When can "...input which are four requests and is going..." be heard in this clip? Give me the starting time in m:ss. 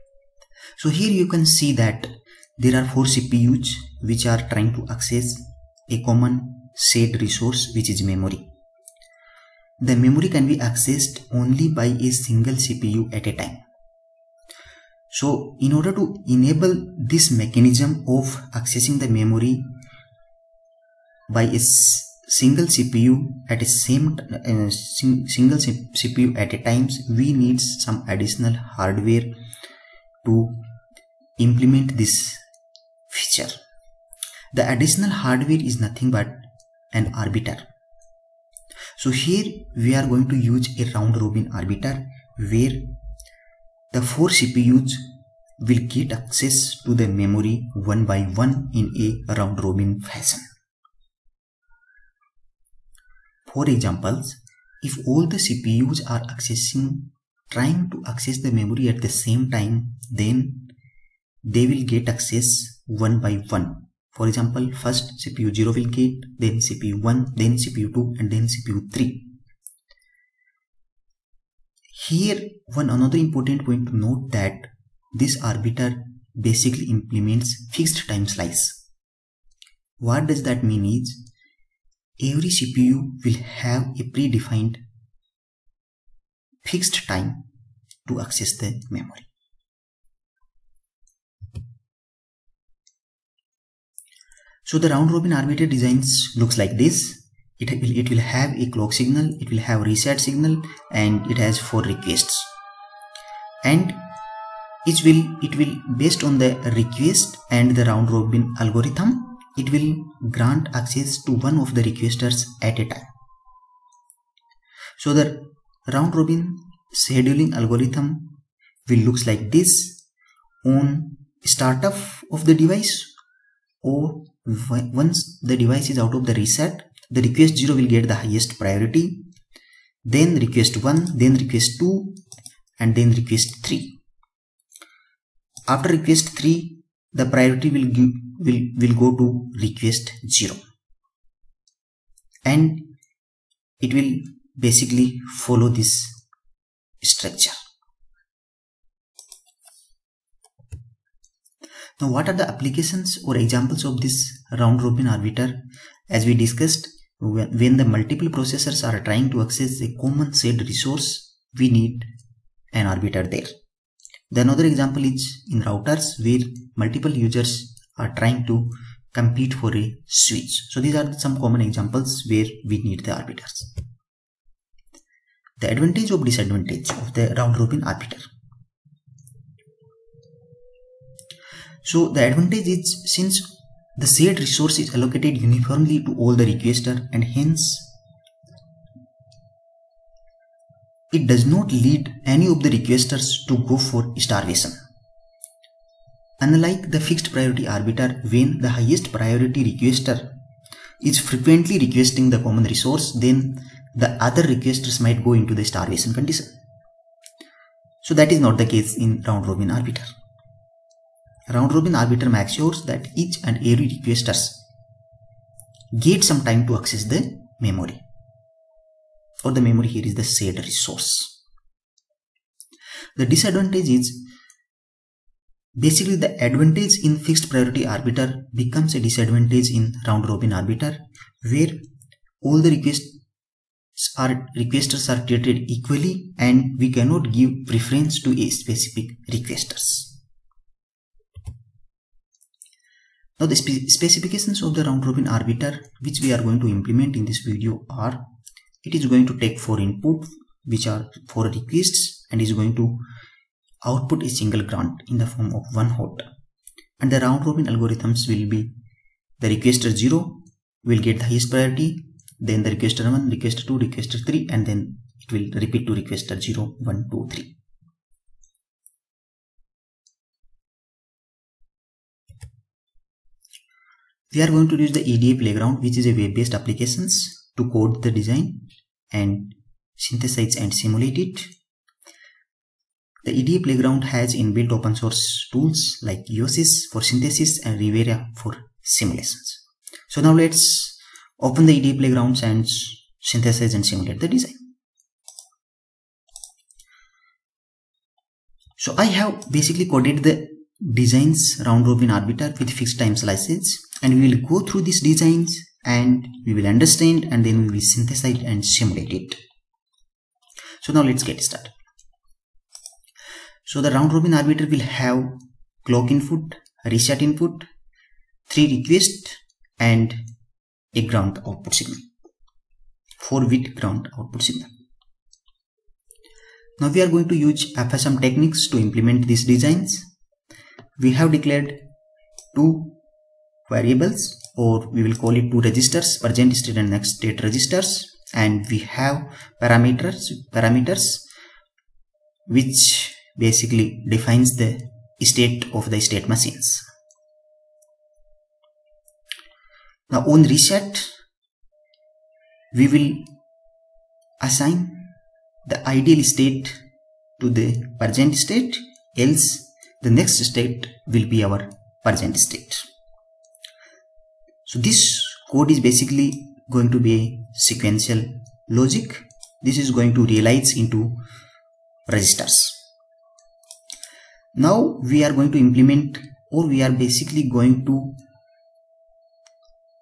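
4:09.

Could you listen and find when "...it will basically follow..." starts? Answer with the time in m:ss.
2:23.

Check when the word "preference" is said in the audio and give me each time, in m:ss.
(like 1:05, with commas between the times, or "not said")
3:57.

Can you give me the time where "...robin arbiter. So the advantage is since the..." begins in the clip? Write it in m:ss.
2:57.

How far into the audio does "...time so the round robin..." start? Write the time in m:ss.
1:52.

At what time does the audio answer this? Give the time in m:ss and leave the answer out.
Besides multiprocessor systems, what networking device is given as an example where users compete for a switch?
2:45.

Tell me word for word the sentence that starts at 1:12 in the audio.
Here one another important point to note that this arbiter basically implements fixed time slice.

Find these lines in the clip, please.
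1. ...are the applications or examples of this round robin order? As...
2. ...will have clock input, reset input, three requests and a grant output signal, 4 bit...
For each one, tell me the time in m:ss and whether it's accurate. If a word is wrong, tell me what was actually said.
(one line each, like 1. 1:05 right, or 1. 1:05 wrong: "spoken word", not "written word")
1. 2:32 wrong: "arbiter", not "order"
2. 5:14 right.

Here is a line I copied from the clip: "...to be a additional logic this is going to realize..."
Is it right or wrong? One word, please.
wrong.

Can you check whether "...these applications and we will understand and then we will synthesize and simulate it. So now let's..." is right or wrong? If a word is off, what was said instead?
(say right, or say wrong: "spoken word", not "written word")
wrong: "designs", not "applications".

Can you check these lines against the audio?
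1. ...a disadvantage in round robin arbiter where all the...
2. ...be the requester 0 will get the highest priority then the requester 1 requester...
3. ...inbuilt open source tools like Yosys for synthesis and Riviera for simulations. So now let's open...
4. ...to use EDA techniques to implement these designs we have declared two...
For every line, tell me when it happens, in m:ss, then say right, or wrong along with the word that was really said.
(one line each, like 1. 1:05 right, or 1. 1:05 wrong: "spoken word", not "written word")
1. 3:48 right
2. 4:18 right
3. 4:44 right
4. 5:27 wrong: "FSM", not "EDA".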